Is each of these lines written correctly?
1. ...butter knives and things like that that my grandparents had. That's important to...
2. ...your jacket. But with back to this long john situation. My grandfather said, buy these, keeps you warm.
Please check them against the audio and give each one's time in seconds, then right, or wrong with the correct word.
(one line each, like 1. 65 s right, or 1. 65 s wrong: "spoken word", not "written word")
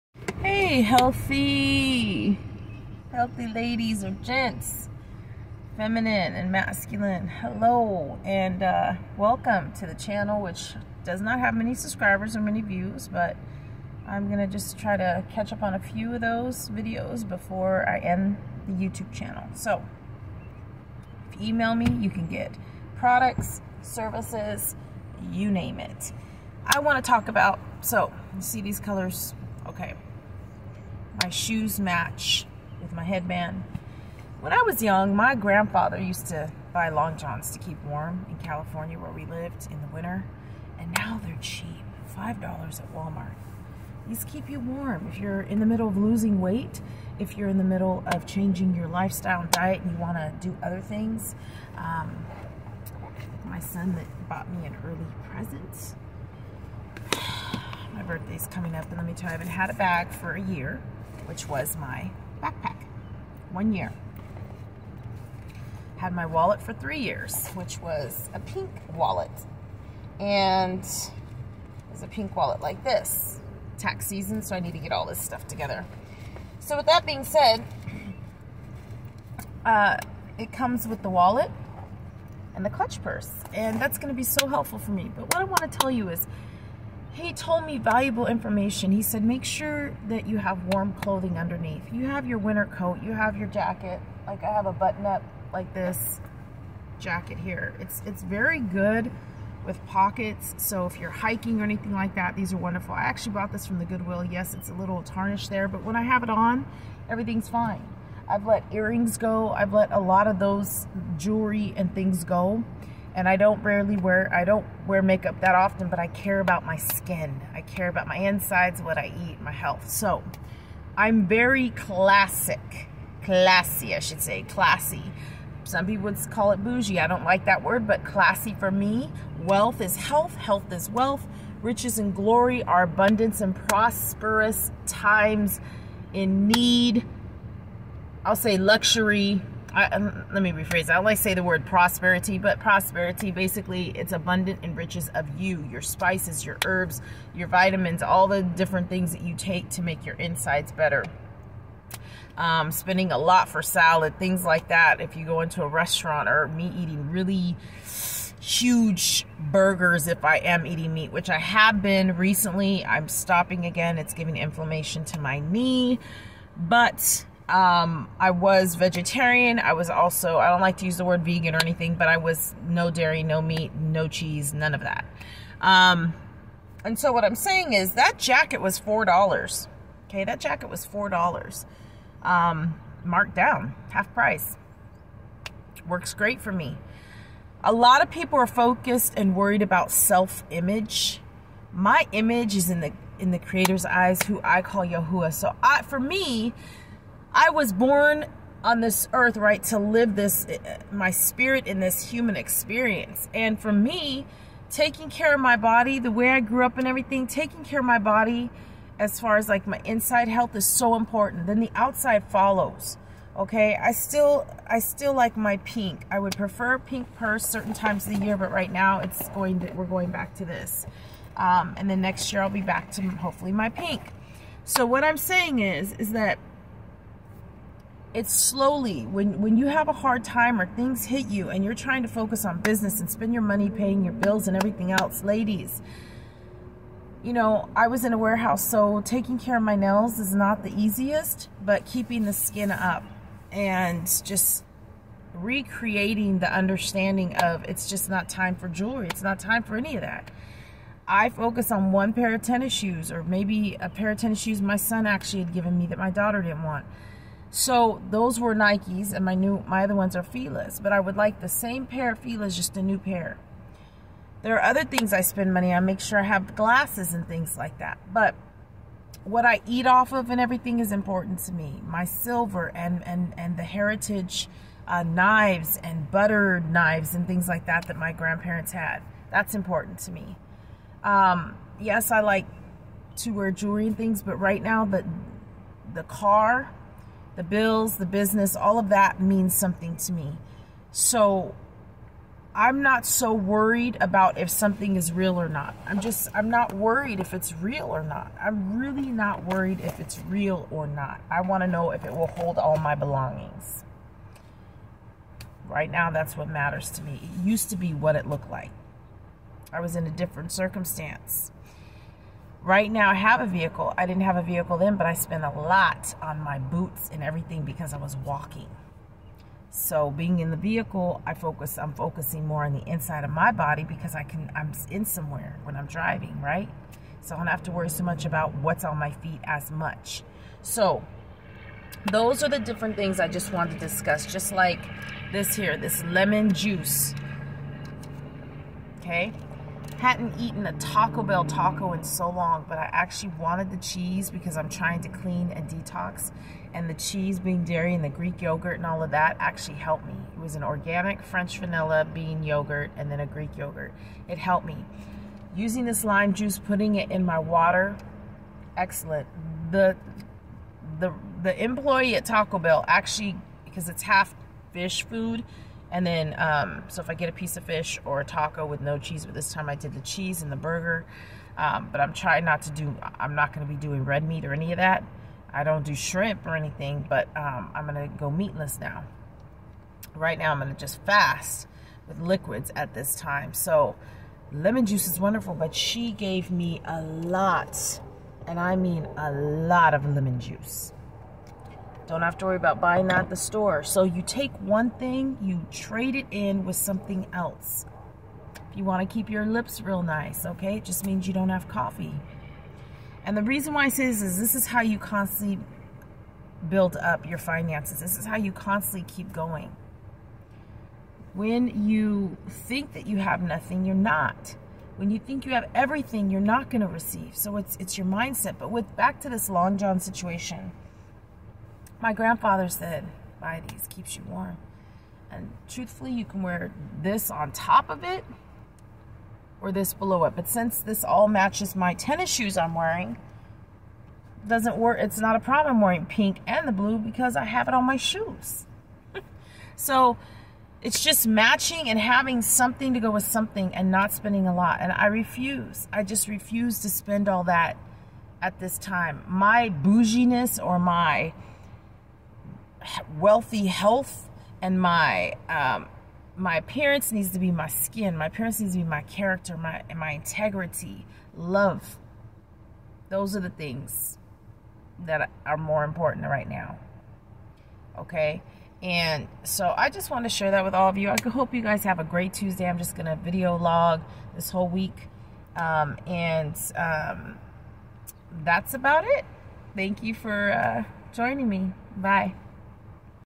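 1. 276 s right
2. 417 s wrong: "mindset", not "jacket".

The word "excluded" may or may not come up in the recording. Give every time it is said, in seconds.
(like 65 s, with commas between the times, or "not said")
not said.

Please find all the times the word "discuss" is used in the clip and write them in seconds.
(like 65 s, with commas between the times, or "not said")
333 s.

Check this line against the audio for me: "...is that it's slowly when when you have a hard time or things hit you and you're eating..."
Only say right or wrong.
wrong.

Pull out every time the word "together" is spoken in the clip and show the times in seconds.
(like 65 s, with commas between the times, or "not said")
75 s.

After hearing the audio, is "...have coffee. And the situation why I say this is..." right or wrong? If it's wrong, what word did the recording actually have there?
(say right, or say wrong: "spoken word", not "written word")
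wrong: "reason", not "situation".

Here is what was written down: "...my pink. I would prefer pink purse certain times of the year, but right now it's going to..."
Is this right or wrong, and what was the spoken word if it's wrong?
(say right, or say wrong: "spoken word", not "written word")
right.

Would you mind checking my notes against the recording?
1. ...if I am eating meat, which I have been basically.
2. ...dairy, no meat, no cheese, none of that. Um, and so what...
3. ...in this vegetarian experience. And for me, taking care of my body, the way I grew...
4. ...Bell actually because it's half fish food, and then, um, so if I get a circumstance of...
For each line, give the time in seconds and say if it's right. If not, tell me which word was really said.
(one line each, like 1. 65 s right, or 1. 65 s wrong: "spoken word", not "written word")
1. 160 s wrong: "recently", not "basically"
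2. 172 s right
3. 201 s wrong: "human", not "vegetarian"
4. 362 s wrong: "piece", not "circumstance".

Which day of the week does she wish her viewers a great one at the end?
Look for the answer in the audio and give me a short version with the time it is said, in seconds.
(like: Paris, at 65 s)
Tuesday, at 472 s.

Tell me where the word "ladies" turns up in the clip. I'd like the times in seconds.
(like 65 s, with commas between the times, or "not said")
3 s, 235 s.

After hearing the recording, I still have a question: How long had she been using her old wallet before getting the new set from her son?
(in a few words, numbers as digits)
3 years.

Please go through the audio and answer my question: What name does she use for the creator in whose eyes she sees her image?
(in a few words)
Yahuwah.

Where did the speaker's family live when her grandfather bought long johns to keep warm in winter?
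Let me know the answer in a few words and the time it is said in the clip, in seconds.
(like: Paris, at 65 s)
California, at 38 s.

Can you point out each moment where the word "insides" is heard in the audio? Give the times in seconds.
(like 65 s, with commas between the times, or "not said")
118 s, 150 s, 209 s, 322 s.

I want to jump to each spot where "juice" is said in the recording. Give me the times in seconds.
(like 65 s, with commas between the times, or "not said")
336 s, 356 s, 384 s, 390 s.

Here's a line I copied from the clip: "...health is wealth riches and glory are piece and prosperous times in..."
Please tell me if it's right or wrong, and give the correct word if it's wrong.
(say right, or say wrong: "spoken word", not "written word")
wrong: "abundance", not "piece".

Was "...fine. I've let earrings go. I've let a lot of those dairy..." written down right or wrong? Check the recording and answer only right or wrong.
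wrong.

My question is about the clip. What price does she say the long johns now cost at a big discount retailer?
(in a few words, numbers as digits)
$5.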